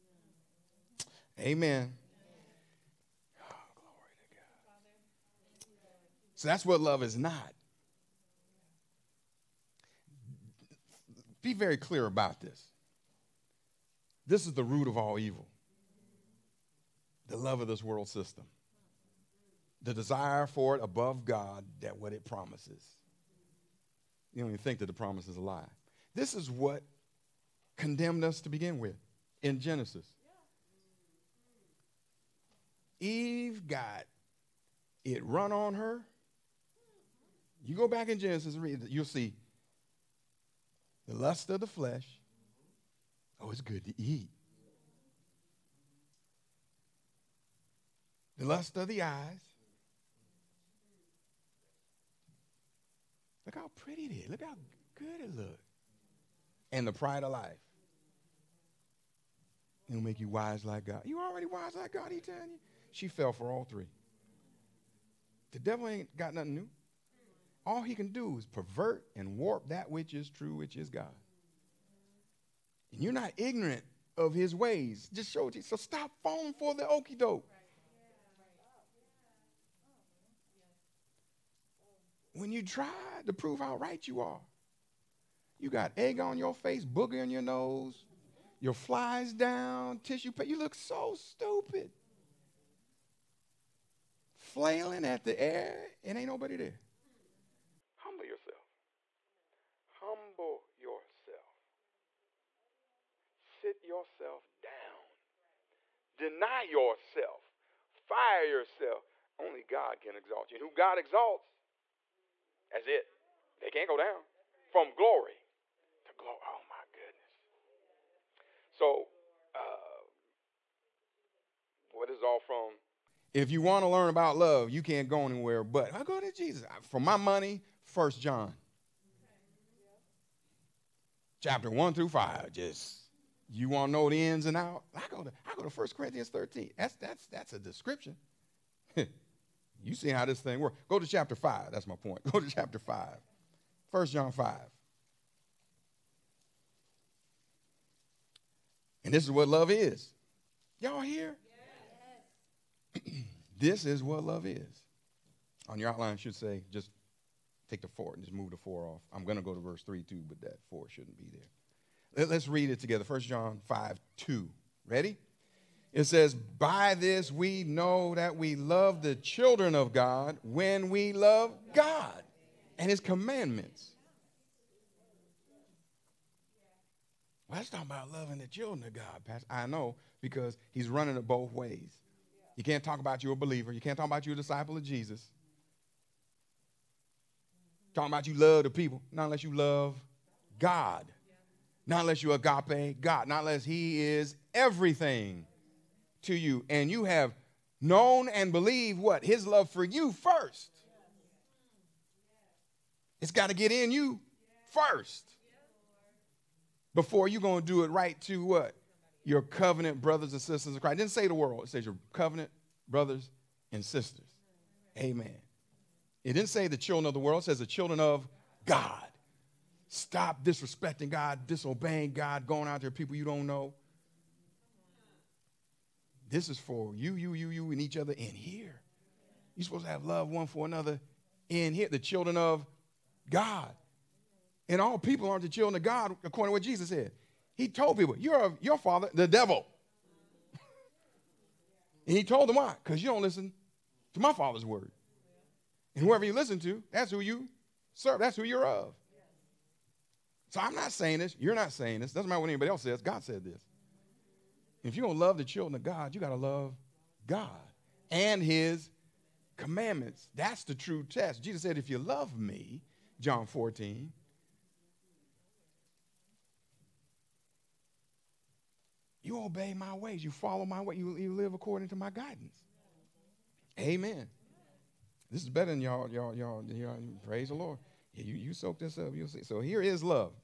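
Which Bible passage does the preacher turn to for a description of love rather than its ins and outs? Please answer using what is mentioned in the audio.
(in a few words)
First Corinthians 13.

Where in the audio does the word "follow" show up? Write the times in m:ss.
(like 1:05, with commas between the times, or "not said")
4:30.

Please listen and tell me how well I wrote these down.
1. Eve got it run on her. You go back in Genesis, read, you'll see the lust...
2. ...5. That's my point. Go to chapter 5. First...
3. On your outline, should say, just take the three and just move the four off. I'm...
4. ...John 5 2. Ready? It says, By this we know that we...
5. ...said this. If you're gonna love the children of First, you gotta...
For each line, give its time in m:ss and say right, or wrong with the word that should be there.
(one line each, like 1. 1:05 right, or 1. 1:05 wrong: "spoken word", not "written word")
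1. 0:32 right
2. 2:21 right
3. 2:35 wrong: "four", not "three"
4. 2:43 right
5. 4:13 wrong: "God", not "First".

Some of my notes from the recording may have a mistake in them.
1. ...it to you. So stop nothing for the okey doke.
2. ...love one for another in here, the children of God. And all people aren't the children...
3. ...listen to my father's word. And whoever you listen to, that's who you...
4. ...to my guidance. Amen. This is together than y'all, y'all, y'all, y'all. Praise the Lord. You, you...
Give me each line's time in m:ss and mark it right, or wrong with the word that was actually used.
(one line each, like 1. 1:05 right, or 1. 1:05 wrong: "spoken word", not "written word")
1. 1:15 wrong: "falling", not "nothing"
2. 3:50 right
3. 4:03 right
4. 4:31 wrong: "better", not "together".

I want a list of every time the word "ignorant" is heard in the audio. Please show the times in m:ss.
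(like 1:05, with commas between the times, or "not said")
1:13.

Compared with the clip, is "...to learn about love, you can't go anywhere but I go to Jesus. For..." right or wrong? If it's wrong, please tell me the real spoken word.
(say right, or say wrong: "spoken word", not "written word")
right.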